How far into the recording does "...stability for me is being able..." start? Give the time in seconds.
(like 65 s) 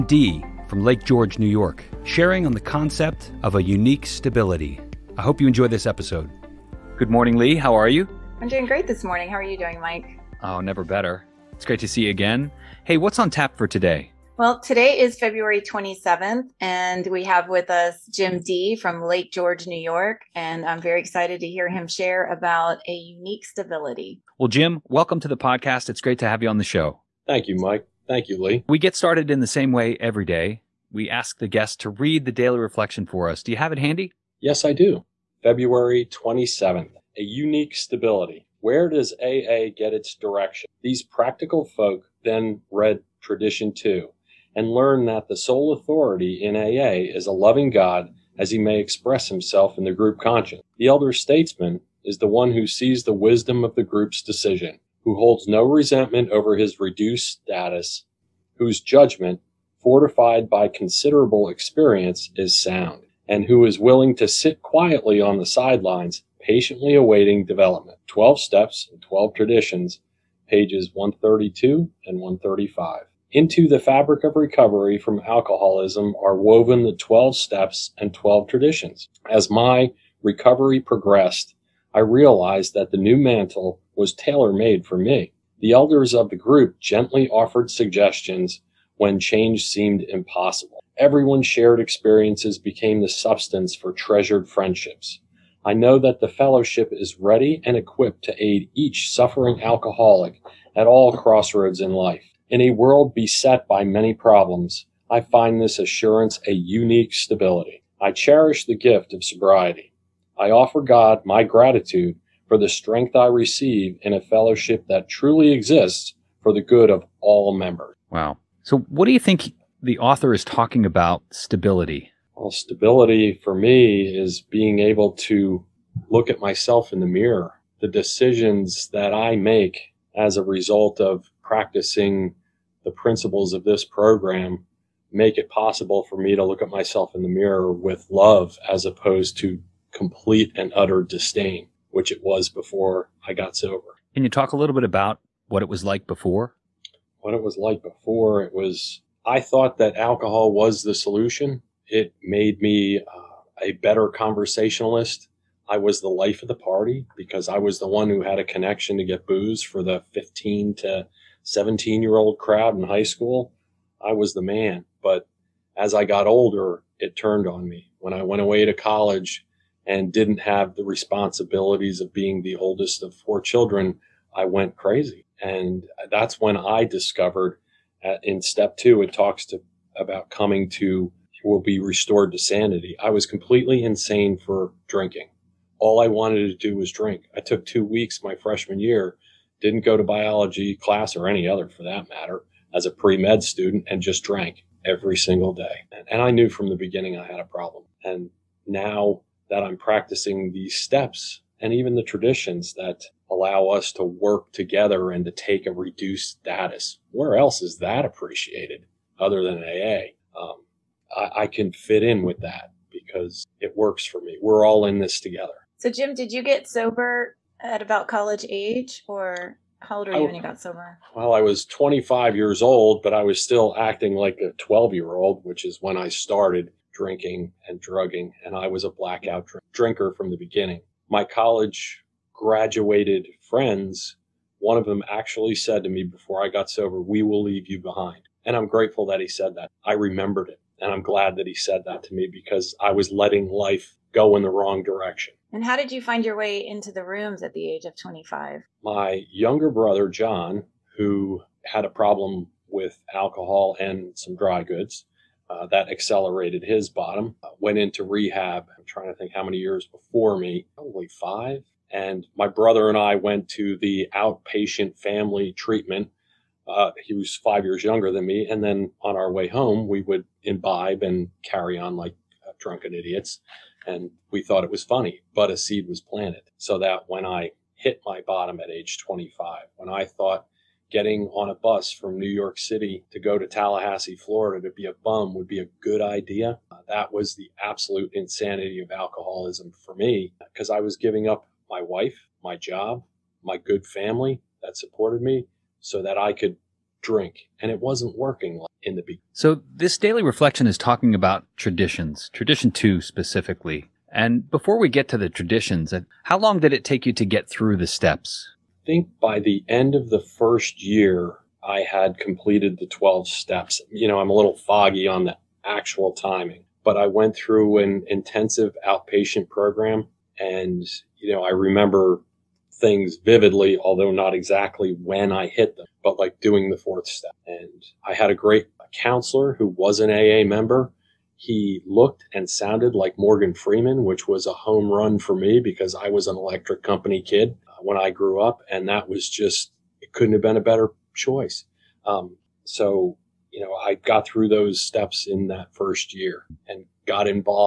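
122 s.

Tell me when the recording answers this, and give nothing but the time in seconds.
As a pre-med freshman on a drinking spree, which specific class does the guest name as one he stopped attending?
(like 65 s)
190 s.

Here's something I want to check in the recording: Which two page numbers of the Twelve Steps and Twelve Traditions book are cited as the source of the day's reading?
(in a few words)
132 and 135.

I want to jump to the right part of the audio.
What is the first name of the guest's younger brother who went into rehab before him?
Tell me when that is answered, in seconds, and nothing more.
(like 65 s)
250 s.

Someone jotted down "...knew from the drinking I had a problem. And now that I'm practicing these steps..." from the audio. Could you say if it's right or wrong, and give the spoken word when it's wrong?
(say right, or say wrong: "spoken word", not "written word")
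wrong: "beginning", not "drinking".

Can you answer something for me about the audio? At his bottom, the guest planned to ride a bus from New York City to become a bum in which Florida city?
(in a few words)
Tallahassee.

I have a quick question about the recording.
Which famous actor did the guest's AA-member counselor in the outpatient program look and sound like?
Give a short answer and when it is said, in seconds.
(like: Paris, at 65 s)
Morgan Freeman, at 333 s.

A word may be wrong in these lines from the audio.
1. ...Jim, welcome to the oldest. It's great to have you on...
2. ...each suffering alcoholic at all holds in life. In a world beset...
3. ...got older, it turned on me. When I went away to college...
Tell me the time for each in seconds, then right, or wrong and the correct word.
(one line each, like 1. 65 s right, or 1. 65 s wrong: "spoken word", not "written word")
1. 24 s wrong: "podcast", not "oldest"
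2. 98 s wrong: "crossroads", not "holds"
3. 166 s right.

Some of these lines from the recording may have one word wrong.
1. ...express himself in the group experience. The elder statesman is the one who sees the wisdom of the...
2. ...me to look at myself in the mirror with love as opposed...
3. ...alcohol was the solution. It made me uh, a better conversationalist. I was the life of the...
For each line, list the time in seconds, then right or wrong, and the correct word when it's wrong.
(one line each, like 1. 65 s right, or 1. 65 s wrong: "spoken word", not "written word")
1. 48 s wrong: "conscience", not "experience"
2. 136 s right
3. 149 s right.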